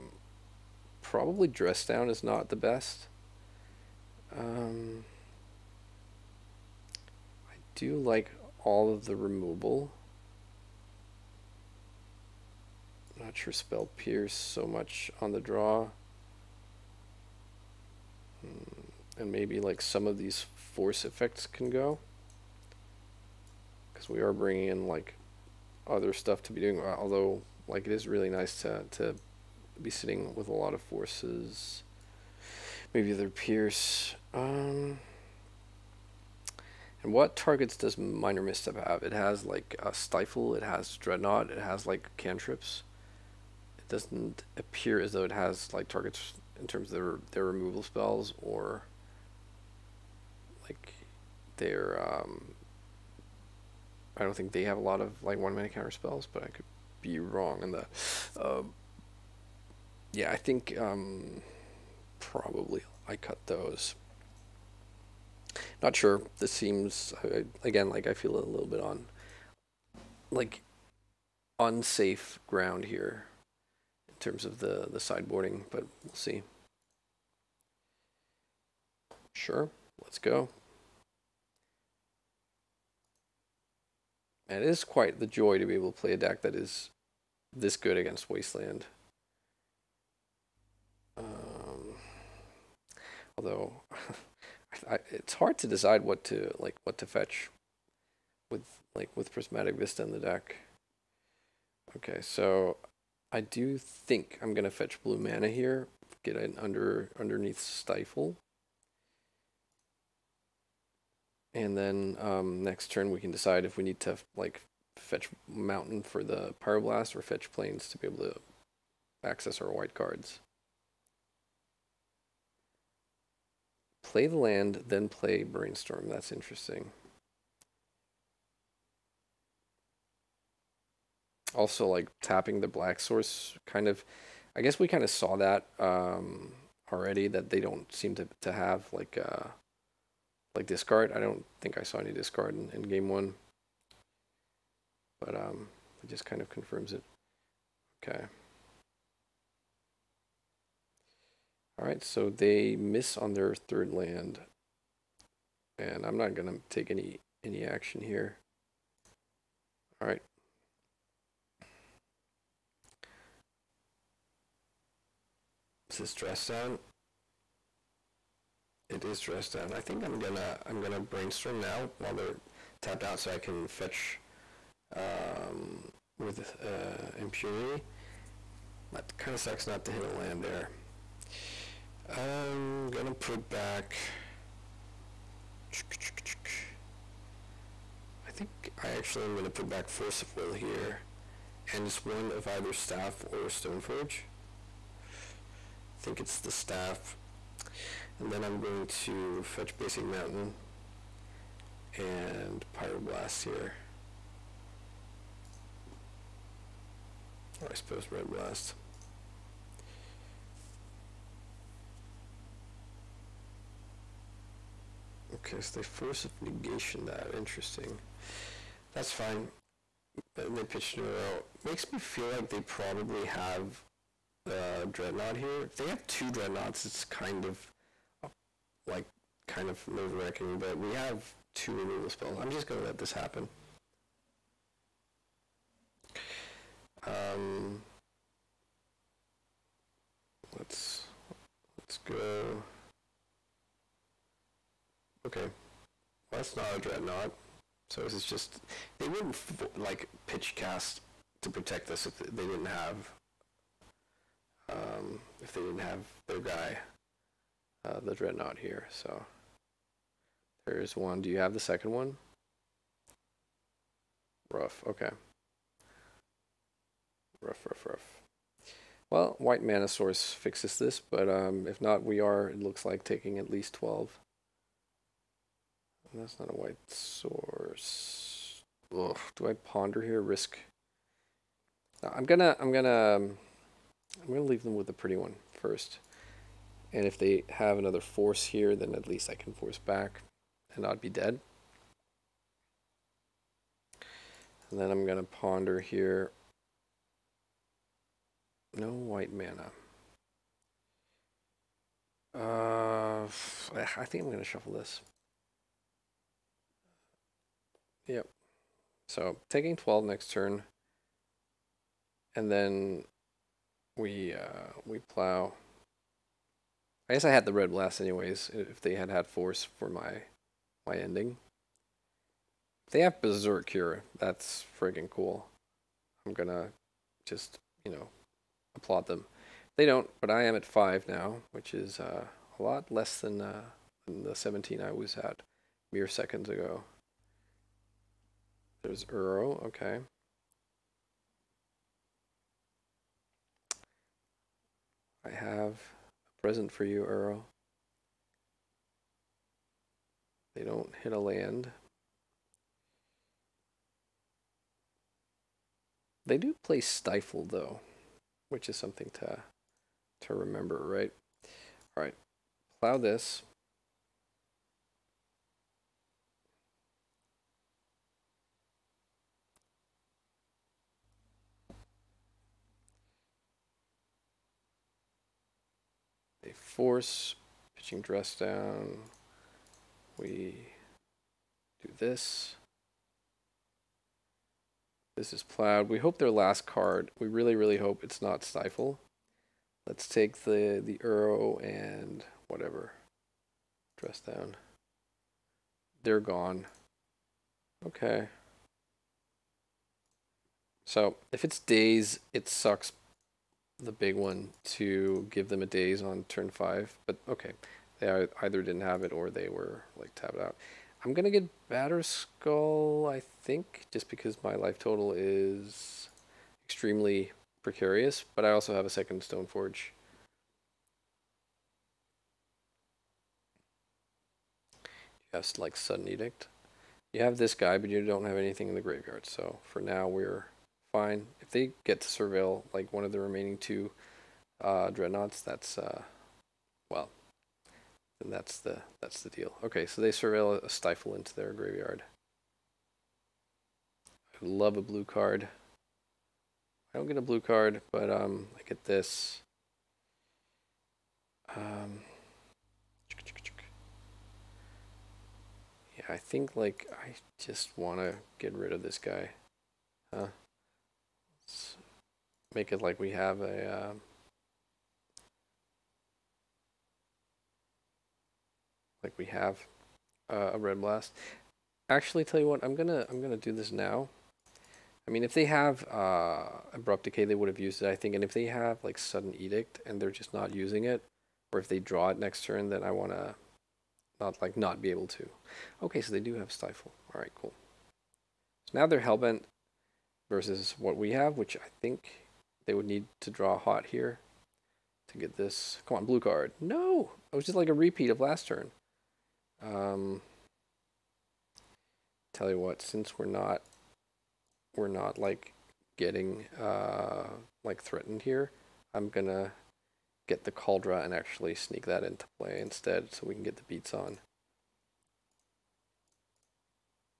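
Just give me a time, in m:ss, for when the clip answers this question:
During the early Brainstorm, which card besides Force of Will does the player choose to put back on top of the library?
3:16.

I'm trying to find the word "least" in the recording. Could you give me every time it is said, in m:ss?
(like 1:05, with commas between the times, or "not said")
4:33, 4:49.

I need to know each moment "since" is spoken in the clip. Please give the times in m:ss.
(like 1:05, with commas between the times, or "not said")
8:22.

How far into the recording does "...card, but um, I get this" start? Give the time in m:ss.
7:27.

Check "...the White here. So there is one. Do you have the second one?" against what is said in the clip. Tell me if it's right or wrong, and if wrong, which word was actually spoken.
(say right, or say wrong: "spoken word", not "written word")
wrong: "Dreadnought", not "White".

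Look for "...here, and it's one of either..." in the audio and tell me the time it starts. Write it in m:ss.
3:10.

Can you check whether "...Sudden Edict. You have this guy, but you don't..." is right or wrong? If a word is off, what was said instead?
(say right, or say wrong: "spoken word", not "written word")
right.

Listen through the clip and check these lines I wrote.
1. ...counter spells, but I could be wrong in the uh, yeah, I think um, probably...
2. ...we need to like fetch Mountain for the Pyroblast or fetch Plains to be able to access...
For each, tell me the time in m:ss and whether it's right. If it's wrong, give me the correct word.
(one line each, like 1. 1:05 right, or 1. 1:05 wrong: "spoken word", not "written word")
1. 0:55 right
2. 1:53 right.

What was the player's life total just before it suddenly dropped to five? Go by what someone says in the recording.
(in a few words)
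17.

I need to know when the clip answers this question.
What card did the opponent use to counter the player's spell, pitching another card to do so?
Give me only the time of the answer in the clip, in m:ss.
3:35.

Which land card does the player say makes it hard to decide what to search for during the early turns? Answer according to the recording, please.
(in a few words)
Prismatic Vista.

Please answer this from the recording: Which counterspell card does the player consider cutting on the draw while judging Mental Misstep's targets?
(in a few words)
Spell Pierce.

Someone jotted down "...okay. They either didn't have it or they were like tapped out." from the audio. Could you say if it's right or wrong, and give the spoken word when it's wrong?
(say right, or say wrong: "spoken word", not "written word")
right.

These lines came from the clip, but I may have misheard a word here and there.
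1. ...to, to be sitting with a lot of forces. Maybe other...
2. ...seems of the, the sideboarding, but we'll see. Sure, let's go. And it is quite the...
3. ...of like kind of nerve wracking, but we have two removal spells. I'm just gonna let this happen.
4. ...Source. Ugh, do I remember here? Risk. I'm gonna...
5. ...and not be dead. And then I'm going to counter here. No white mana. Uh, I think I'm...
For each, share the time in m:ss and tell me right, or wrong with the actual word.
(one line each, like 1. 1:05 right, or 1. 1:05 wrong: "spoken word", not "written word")
1. 0:28 right
2. 1:14 wrong: "terms", not "seems"
3. 3:47 right
4. 4:36 wrong: "ponder", not "remember"
5. 4:50 wrong: "ponder", not "counter".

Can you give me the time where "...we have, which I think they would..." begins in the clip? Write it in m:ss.
8:10.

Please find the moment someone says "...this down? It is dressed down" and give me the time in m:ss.
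2:46.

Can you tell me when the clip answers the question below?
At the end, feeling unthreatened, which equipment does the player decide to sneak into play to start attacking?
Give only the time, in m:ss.
8:30.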